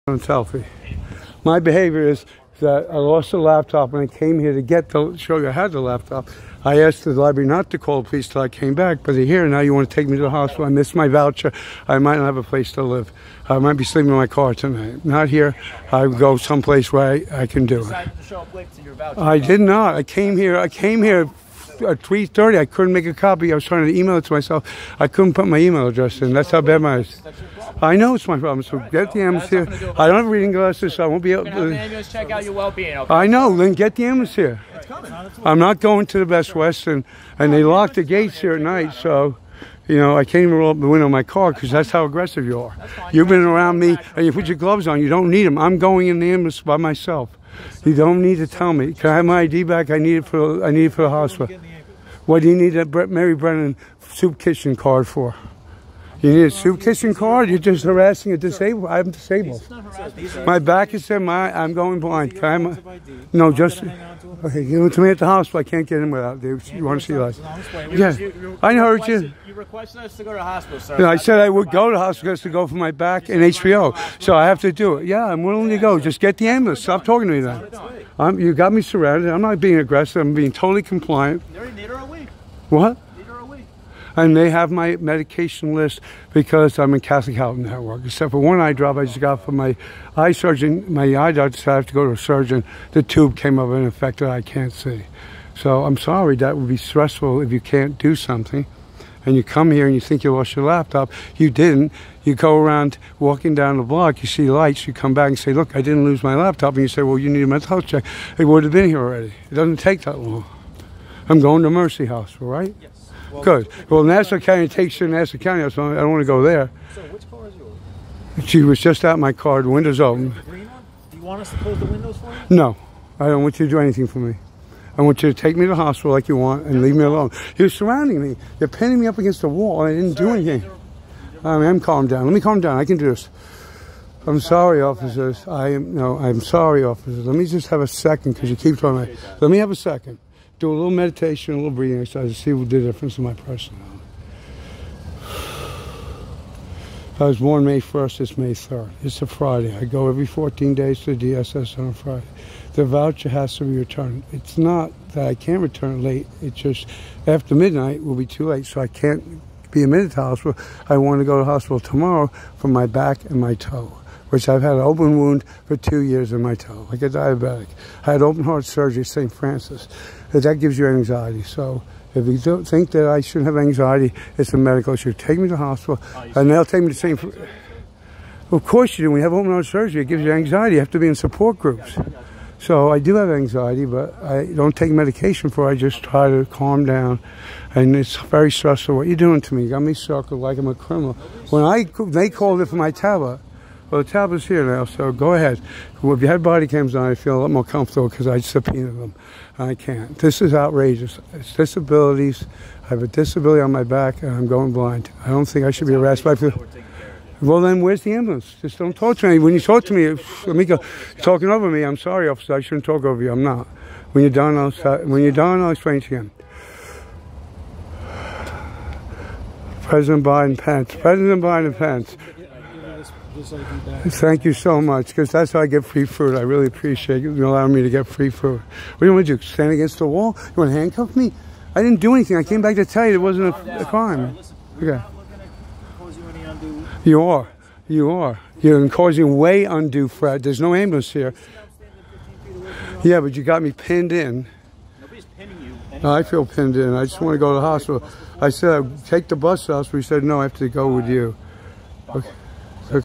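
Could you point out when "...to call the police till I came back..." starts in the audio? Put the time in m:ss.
0:07.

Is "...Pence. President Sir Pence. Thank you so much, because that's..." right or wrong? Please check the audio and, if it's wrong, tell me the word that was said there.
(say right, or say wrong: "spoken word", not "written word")
wrong: "Biden", not "Sir".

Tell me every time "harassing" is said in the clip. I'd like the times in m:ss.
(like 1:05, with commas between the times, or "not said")
0:57.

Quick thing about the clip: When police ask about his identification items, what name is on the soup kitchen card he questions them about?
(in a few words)
Mary Brennan.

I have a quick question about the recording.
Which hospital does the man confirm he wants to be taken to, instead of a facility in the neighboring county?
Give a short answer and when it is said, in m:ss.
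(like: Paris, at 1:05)
Mercy Hospital, at 1:51.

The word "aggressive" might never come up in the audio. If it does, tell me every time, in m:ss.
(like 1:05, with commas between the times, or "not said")
0:42, 1:19.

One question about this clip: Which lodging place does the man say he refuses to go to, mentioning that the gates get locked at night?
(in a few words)
Best Western.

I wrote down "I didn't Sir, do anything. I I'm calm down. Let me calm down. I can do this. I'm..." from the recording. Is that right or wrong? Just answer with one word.
right.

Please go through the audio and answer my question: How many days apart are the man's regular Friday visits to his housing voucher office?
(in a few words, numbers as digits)
14.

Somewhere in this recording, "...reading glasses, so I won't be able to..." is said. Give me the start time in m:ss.
0:30.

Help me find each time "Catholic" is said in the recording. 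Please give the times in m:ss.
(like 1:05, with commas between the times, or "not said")
1:27.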